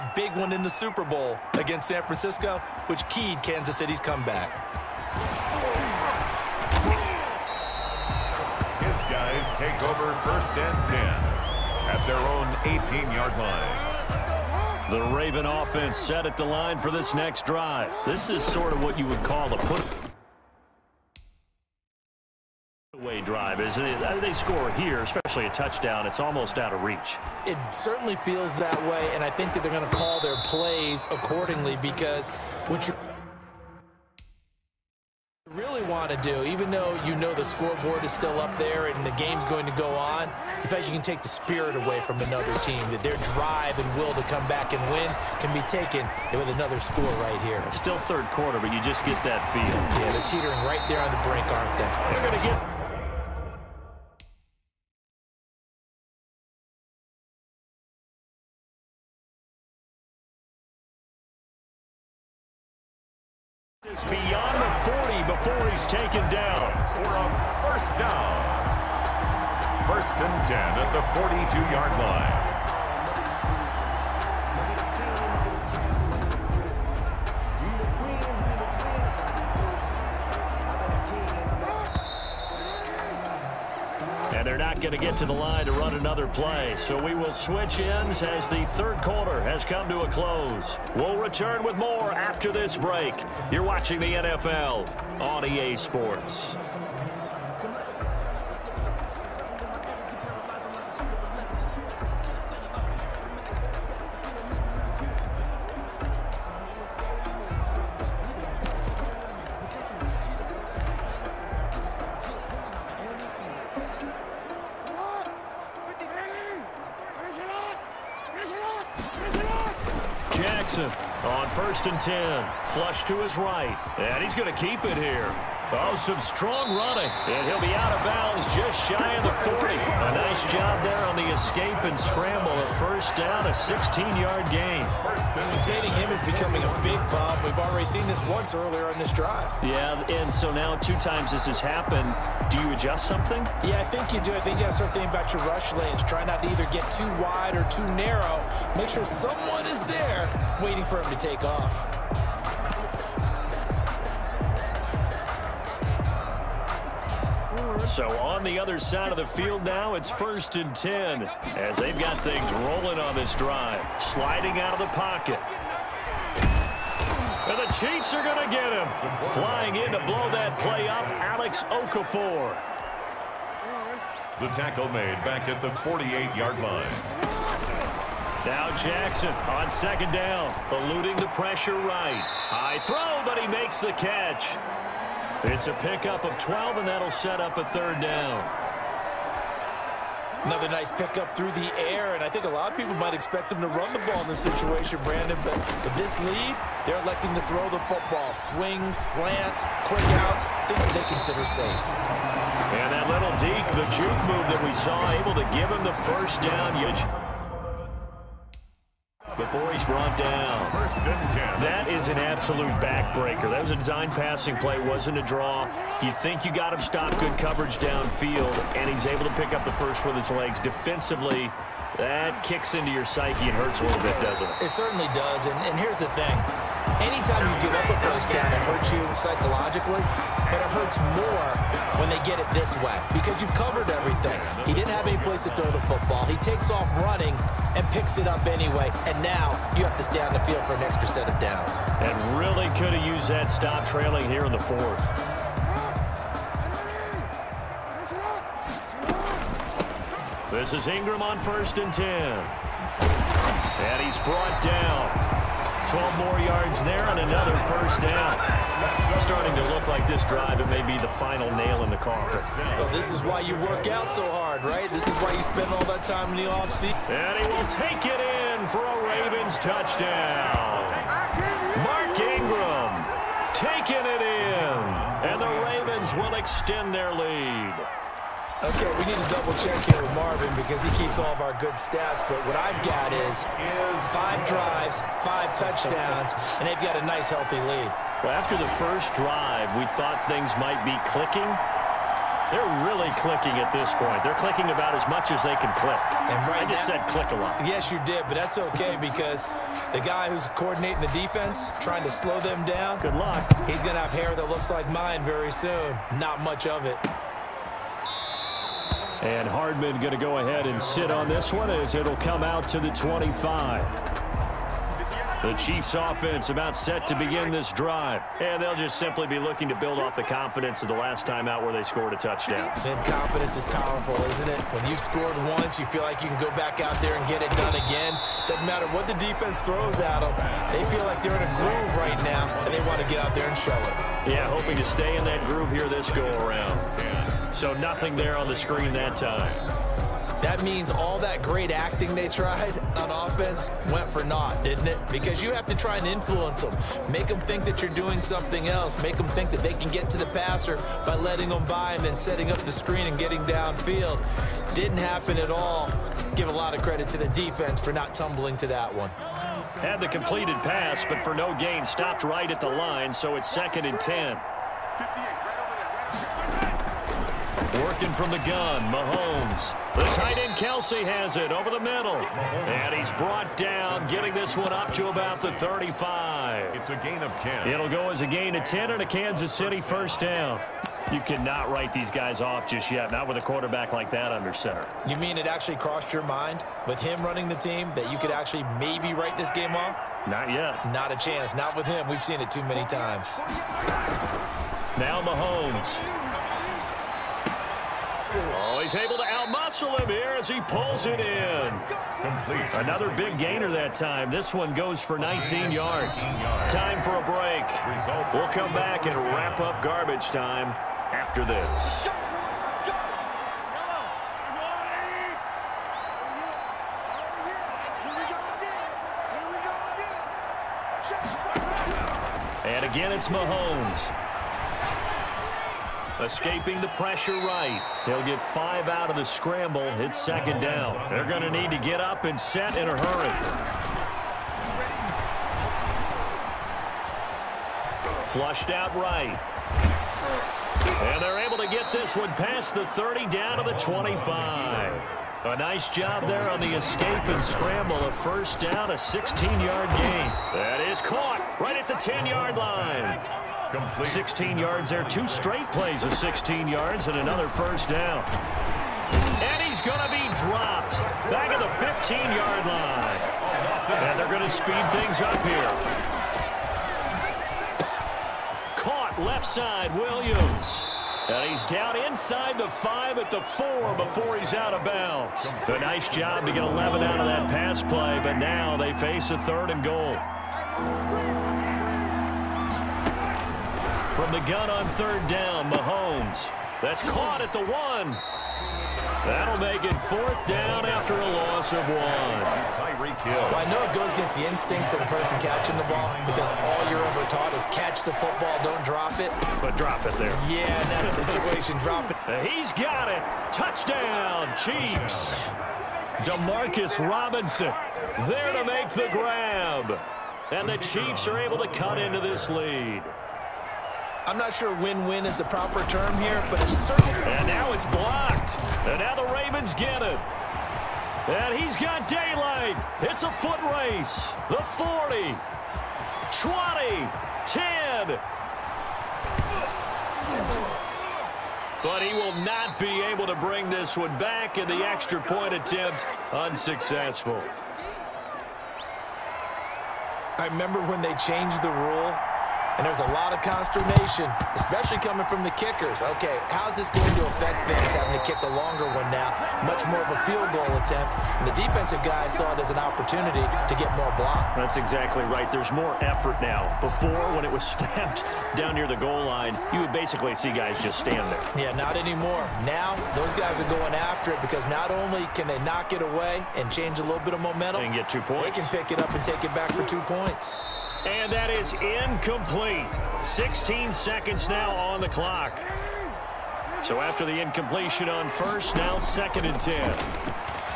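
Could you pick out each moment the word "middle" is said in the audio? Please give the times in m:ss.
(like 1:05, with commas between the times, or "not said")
6:11.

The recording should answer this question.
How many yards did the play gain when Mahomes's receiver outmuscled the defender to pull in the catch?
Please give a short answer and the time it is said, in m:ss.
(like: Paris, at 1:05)
19, at 6:45.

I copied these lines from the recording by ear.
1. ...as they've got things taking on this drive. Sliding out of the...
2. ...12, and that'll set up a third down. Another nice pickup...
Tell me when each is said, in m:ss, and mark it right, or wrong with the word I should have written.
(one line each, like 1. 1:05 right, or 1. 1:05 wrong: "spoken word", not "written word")
1. 2:41 wrong: "rolling", not "taking"
2. 3:06 right.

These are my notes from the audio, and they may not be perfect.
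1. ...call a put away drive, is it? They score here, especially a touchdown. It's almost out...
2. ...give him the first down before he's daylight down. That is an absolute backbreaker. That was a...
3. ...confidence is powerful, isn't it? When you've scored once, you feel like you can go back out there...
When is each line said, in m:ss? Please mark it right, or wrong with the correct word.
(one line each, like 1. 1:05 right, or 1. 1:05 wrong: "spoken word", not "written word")
1. 0:19 right
2. 3:25 wrong: "brought", not "daylight"
3. 5:23 right.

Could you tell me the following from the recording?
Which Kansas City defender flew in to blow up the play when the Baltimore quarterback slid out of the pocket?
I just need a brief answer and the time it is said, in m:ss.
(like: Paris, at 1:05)
Alex Okafor, at 2:51.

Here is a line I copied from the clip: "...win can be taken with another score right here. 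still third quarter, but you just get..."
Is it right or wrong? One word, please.
right.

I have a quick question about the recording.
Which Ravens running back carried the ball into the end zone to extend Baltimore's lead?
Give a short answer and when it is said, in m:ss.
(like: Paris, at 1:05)
Mark Ingram, at 4:31.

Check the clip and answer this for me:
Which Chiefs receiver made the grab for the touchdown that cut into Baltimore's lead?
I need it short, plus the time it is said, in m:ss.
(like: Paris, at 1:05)
DeMarcus Robinson, at 8:26.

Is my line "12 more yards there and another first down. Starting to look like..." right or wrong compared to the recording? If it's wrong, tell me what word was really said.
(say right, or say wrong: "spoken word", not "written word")
right.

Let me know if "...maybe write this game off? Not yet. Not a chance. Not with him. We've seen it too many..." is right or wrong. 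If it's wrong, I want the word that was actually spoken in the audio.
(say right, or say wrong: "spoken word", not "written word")
right.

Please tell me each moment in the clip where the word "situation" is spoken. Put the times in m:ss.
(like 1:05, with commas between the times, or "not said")
3:14, 8:21.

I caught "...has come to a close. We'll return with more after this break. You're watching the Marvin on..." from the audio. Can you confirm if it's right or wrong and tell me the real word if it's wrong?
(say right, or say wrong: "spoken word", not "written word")
wrong: "NFL", not "Marvin".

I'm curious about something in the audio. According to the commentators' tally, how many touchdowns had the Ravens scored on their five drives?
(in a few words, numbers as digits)
5.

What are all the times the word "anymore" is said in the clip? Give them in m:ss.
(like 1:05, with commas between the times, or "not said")
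9:21.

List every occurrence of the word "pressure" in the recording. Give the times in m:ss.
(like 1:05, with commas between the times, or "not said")
3:01, 7:06.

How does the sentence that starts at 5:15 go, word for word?
The Chiefs offense about set to begin this drive.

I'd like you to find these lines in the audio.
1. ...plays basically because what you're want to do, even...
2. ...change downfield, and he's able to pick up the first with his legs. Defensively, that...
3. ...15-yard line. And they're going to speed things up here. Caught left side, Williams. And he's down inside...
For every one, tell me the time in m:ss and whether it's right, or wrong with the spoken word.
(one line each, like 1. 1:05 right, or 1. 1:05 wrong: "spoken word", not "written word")
1. 0:30 wrong: "accordingly", not "basically"
2. 3:37 wrong: "coverage", not "change"
3. 7:41 right.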